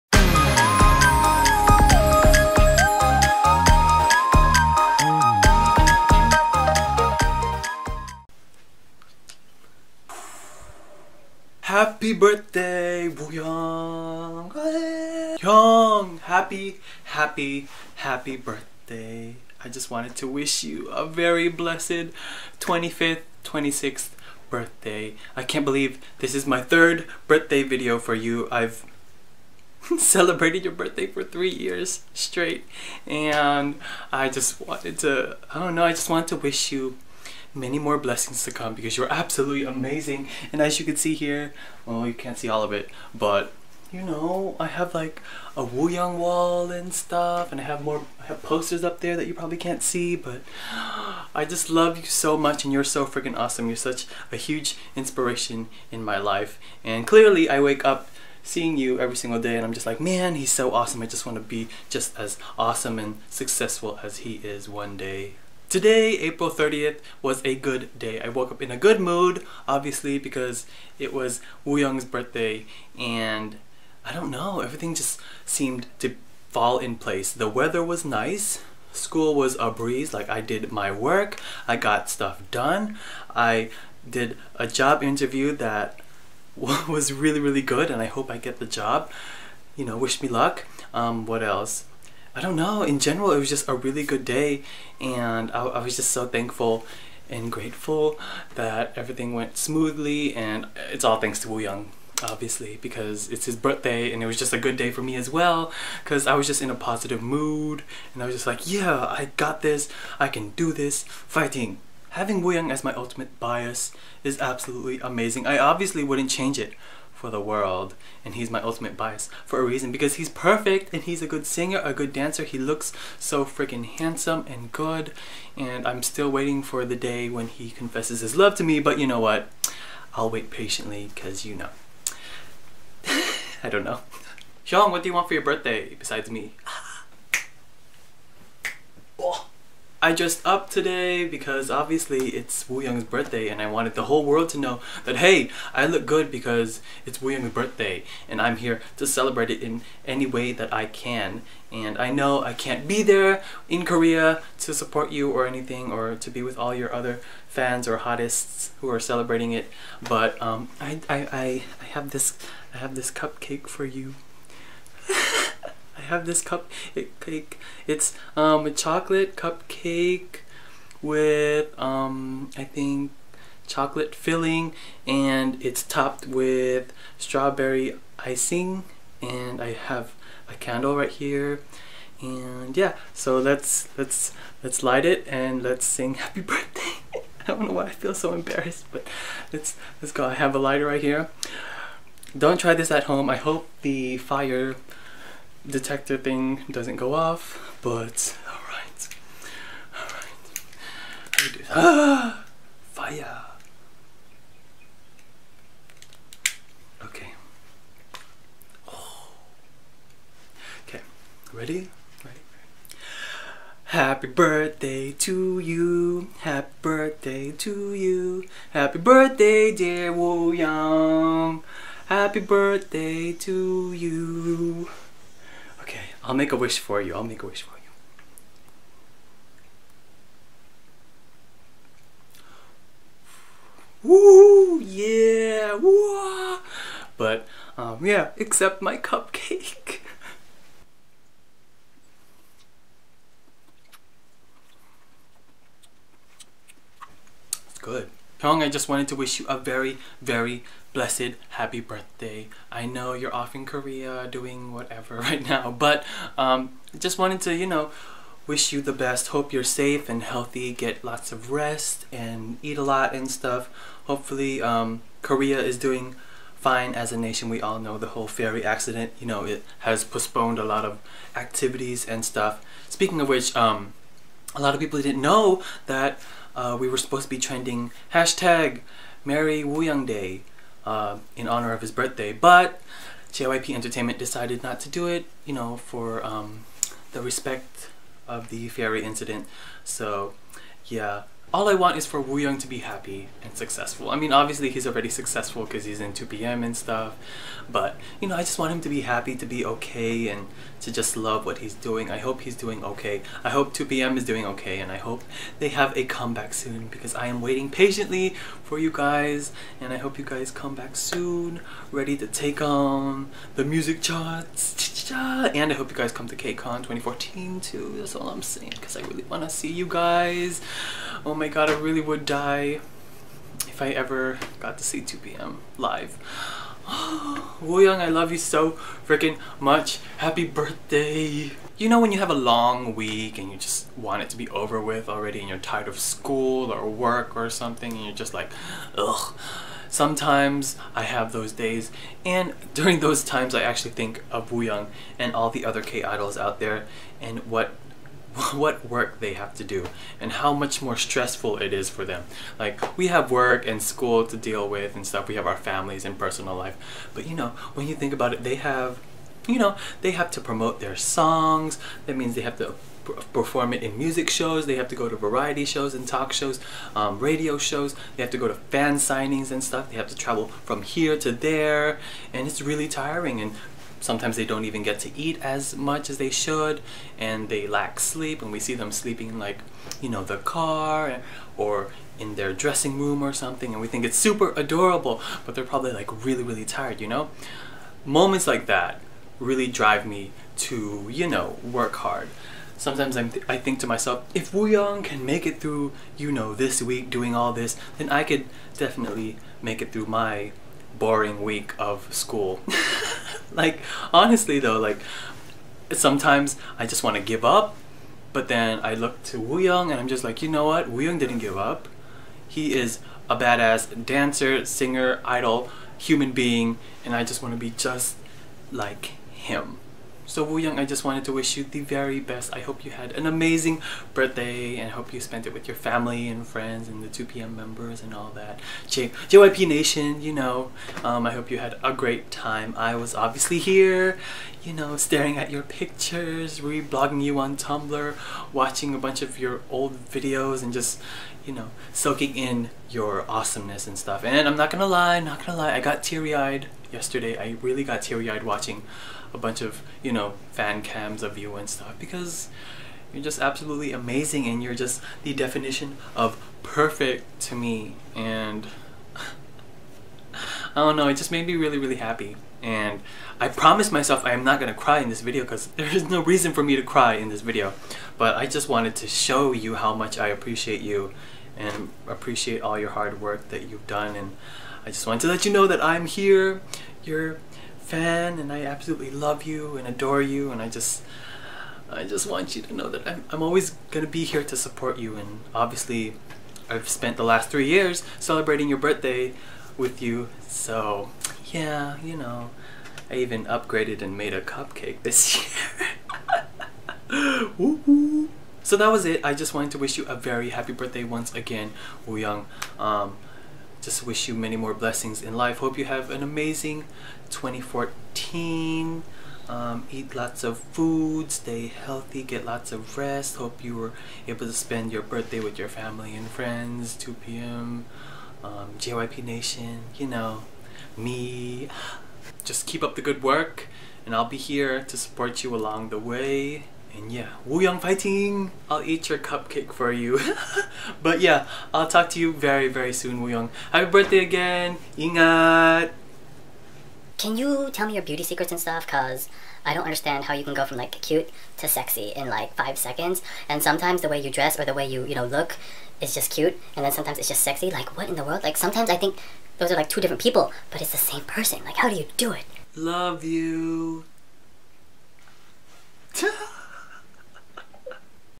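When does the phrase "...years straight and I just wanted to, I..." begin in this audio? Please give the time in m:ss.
0:31.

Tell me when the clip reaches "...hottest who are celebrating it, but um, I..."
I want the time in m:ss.
2:37.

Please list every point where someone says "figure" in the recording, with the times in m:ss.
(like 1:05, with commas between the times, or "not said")
not said.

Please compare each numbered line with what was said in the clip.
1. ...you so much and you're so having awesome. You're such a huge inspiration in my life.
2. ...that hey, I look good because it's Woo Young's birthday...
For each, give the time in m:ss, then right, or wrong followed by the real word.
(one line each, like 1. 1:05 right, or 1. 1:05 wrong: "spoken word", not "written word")
1. 0:51 wrong: "freaking", not "having"
2. 2:25 right.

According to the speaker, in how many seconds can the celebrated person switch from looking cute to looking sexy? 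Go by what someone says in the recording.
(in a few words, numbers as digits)
5.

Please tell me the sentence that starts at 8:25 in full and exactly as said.
Hope you have an amazing 2014.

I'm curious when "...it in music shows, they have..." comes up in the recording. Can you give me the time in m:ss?
6:03.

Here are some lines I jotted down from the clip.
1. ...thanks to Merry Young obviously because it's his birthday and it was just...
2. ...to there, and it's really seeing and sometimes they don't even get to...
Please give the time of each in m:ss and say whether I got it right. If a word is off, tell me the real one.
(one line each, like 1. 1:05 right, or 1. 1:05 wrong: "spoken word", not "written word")
1. 1:41 wrong: "Woo", not "Merry"
2. 6:11 wrong: "tiring", not "seeing".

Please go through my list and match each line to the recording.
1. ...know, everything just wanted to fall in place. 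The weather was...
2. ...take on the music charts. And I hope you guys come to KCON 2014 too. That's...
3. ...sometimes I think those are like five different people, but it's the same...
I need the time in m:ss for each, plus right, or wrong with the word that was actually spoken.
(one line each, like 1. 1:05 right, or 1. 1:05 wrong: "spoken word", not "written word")
1. 1:14 wrong: "seemed", not "wanted"
2. 5:12 right
3. 9:08 wrong: "two", not "five".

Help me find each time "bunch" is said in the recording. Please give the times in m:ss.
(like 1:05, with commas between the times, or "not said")
7:18, 7:29.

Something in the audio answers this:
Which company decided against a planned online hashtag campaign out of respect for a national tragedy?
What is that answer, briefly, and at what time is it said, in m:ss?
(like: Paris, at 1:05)
JYP Entertainment, at 4:43.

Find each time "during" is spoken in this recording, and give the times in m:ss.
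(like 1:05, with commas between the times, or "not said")
5:42.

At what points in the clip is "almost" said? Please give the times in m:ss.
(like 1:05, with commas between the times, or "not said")
not said.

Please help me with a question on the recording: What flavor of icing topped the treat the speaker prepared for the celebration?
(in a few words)
strawberry.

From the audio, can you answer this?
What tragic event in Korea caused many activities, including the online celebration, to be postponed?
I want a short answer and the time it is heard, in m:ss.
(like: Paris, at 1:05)
ferry accident, at 4:28.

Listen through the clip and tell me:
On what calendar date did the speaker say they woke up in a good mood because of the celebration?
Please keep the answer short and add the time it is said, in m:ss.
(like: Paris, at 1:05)
April 30th, at 1:06.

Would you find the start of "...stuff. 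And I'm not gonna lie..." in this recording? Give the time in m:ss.
7:23.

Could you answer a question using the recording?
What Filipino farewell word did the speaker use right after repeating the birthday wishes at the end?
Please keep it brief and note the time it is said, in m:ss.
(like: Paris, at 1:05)
Ingat, at 8:54.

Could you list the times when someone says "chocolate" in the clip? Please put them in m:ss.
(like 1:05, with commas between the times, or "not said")
2:48, 2:53.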